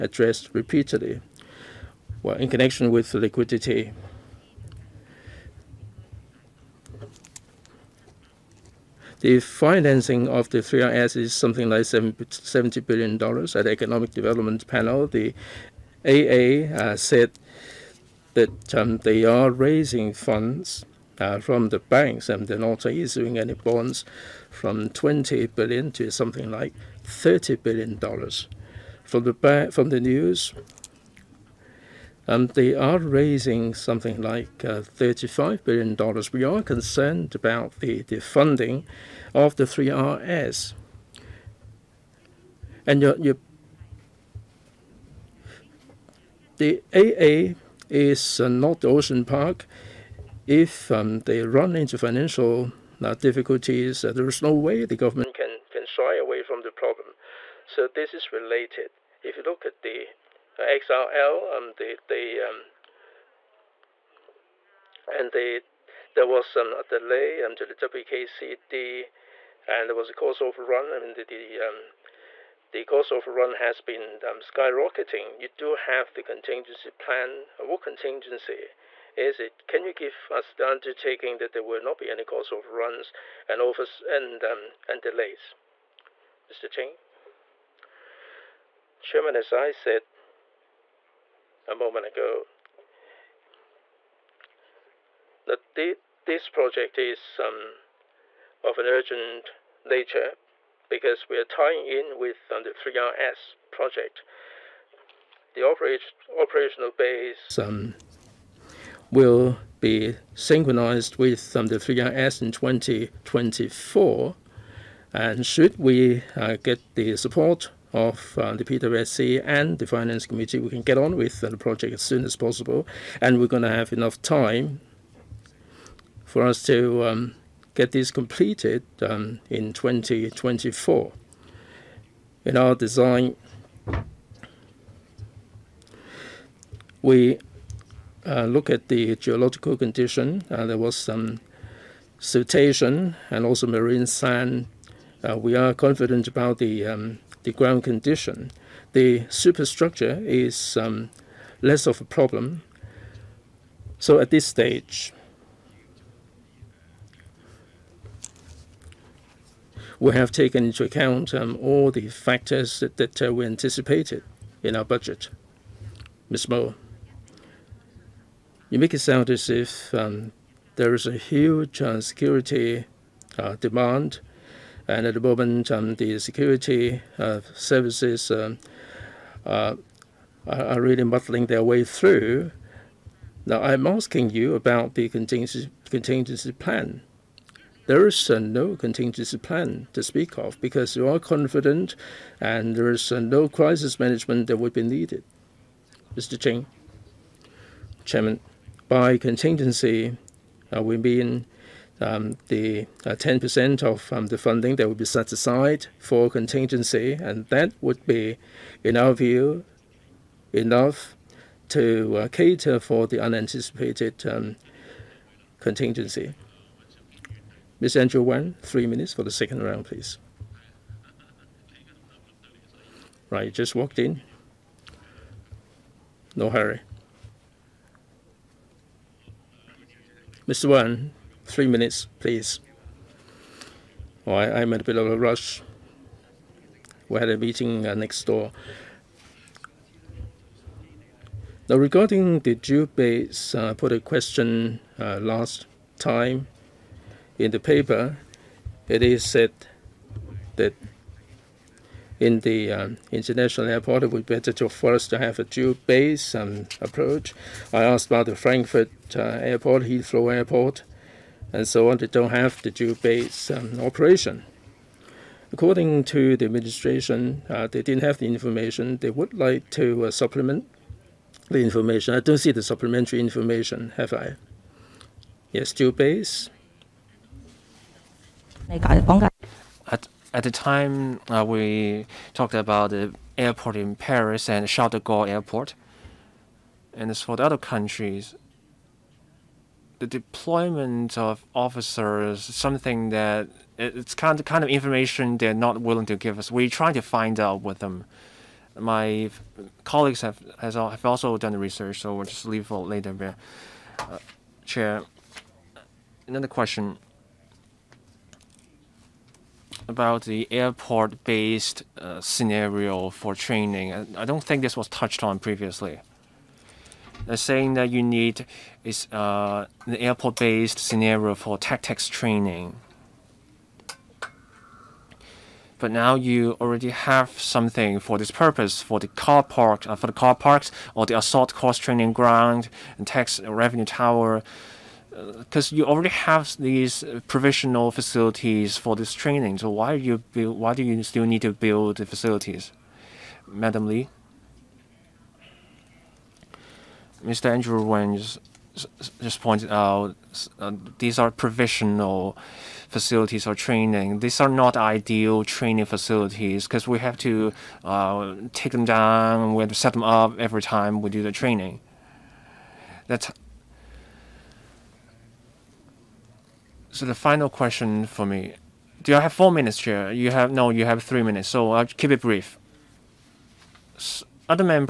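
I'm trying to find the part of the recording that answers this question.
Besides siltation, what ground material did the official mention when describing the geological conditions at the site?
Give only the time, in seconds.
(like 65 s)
143 s.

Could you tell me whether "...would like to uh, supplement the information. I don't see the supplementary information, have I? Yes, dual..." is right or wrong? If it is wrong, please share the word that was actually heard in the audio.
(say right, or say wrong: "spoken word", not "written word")
right.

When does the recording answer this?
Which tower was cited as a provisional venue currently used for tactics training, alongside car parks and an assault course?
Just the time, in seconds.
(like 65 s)
333 s.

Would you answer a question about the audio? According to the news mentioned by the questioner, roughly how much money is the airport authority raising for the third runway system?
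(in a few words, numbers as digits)
$35 billion.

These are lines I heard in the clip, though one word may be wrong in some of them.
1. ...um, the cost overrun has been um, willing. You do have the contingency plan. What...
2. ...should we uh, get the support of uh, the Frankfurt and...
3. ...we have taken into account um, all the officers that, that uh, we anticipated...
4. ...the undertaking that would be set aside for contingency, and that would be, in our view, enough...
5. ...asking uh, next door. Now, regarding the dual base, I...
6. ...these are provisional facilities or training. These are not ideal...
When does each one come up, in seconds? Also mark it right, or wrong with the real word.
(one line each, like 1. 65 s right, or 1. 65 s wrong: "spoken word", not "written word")
1. 71 s wrong: "skyrocketing", not "willing"
2. 115 s wrong: "PWSC", not "Frankfurt"
3. 159 s wrong: "factors", not "officers"
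4. 204 s wrong: "funding", not "undertaking"
5. 237 s wrong: "meeting", not "asking"
6. 350 s right.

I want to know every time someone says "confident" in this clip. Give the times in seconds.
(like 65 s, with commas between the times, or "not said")
145 s, 191 s.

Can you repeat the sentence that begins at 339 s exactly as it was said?
So why you build, why do you still need to build the facilities, Madam Lee?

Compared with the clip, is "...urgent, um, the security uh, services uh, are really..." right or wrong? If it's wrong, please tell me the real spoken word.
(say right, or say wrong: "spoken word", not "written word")
wrong: "moment", not "urgent".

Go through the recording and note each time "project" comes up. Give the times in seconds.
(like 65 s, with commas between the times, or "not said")
96 s, 103 s, 121 s.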